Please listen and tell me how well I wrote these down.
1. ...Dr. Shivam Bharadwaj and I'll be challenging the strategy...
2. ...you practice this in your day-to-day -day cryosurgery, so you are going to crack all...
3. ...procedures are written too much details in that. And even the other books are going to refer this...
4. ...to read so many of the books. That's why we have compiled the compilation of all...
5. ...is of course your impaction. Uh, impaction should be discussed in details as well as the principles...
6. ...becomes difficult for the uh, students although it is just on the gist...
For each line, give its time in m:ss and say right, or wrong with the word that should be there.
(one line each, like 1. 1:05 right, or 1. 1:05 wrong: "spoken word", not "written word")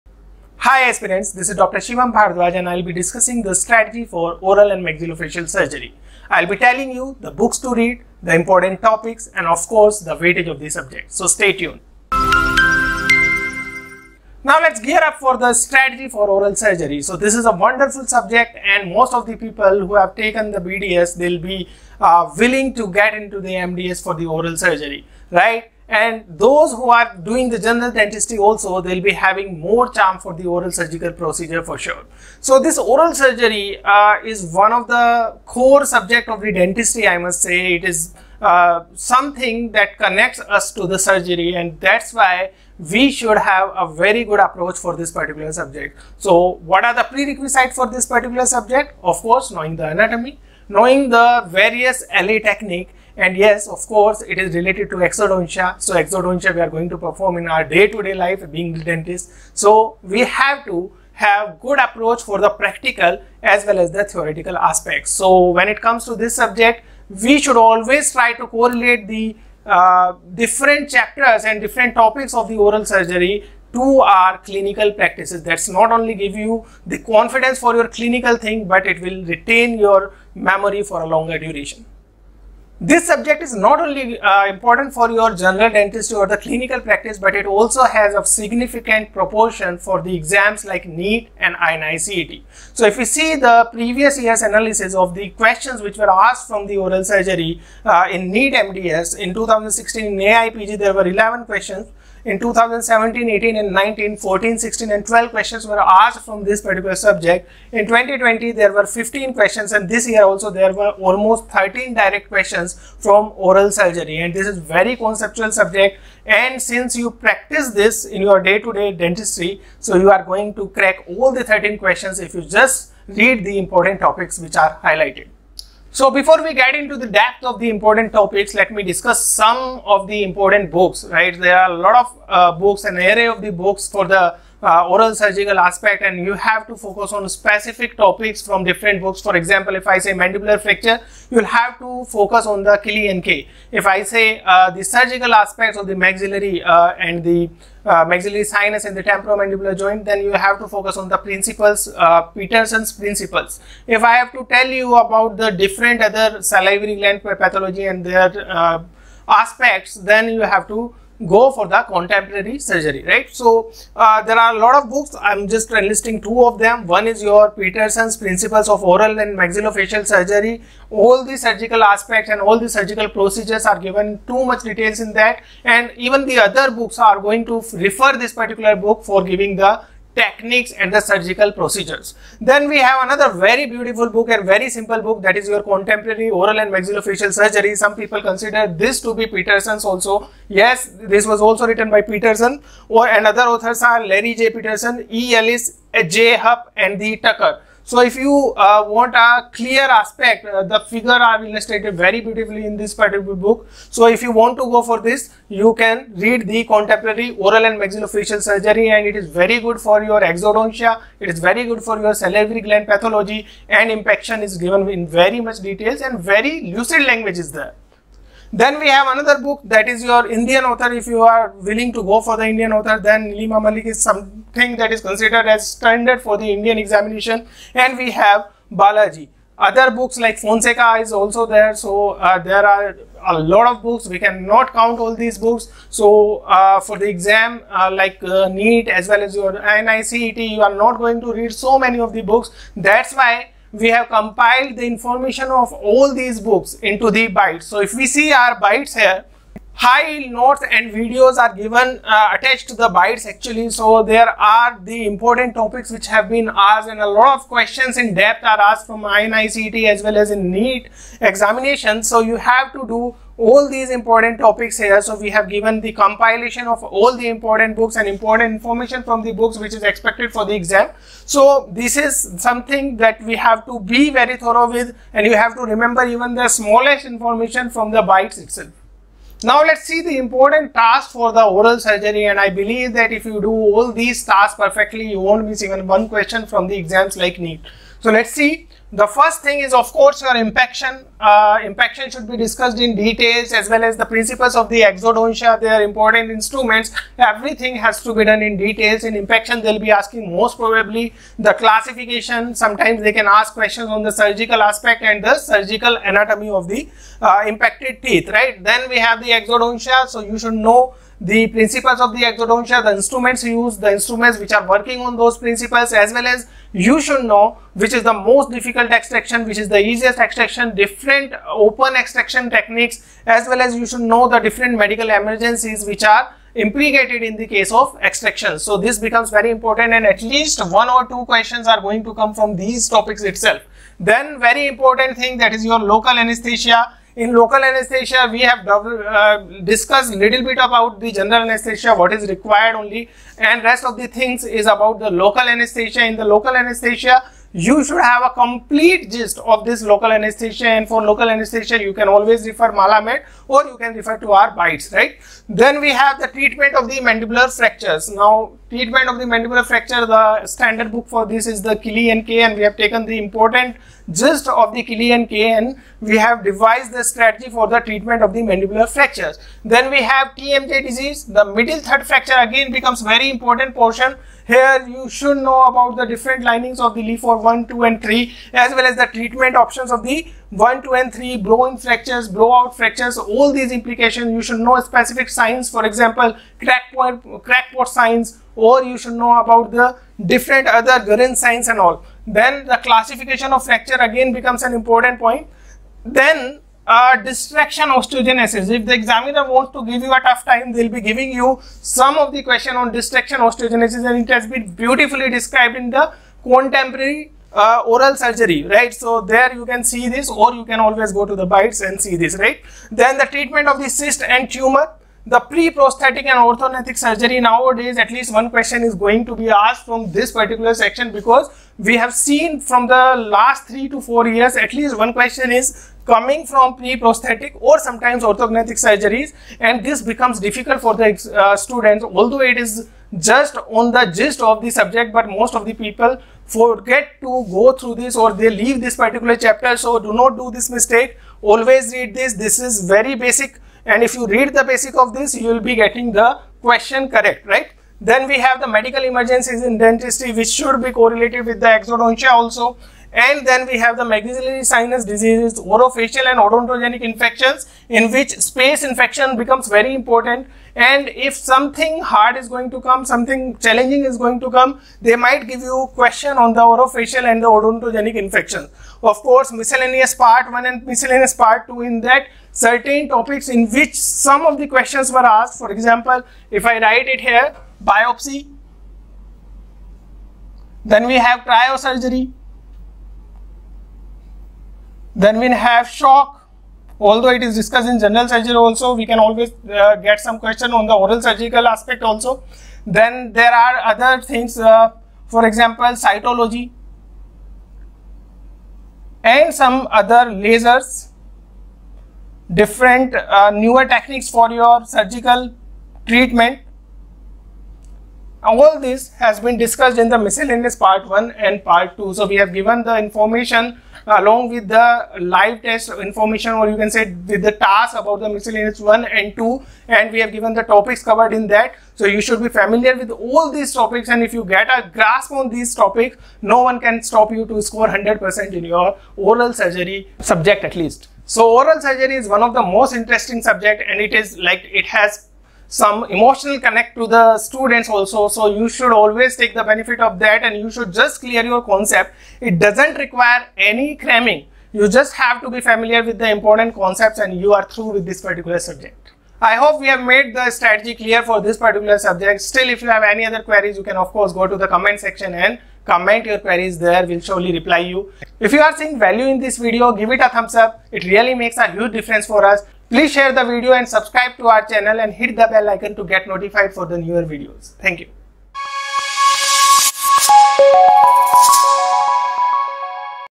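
1. 0:01 wrong: "discussing", not "challenging"
2. 1:56 wrong: "dentistry", not "cryosurgery"
3. 2:53 wrong: "given", not "written"
4. 4:01 wrong: "information", not "compilation"
5. 4:49 right
6. 7:10 right.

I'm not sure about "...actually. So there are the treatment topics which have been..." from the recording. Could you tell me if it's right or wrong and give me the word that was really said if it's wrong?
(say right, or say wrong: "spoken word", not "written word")
wrong: "important", not "treatment".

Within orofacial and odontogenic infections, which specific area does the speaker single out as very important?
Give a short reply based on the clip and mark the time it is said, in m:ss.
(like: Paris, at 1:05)
Space infection, at 7:38.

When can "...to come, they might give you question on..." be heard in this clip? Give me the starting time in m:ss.
7:44.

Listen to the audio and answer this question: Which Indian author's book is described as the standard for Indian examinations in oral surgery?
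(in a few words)
Neelima Malik.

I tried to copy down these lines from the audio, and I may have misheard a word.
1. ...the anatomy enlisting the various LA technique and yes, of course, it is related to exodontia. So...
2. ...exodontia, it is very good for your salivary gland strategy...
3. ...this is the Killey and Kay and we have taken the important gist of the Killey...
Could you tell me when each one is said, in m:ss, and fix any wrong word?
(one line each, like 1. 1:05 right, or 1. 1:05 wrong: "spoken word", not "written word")
1. 0:49 wrong: "knowing", not "enlisting"
2. 3:30 wrong: "pathology", not "strategy"
3. 6:01 right.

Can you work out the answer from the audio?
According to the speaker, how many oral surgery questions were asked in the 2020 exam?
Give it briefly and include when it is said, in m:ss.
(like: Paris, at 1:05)
15, at 1:48.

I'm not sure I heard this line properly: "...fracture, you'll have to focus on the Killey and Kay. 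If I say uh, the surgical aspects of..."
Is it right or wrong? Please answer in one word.
right.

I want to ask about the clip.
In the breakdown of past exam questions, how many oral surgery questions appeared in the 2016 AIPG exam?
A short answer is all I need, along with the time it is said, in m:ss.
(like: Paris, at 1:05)
11, at 1:41.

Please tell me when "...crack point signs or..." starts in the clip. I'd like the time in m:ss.
6:27.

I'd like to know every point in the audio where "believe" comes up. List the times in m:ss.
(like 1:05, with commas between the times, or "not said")
4:42.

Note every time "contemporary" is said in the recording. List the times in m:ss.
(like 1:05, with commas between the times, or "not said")
2:41, 3:05, 3:26, 6:46.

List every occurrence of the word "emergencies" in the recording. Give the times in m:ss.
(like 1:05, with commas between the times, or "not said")
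5:25, 7:29.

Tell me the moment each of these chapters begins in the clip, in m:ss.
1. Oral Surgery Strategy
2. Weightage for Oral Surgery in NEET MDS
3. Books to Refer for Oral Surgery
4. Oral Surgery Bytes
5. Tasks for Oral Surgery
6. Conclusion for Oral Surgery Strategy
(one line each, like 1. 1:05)
1. 0:14
2. 1:22
3. 2:06
4. 4:09
5. 4:39
6. 8:50.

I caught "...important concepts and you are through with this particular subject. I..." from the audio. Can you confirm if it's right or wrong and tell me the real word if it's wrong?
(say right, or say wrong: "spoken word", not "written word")
right.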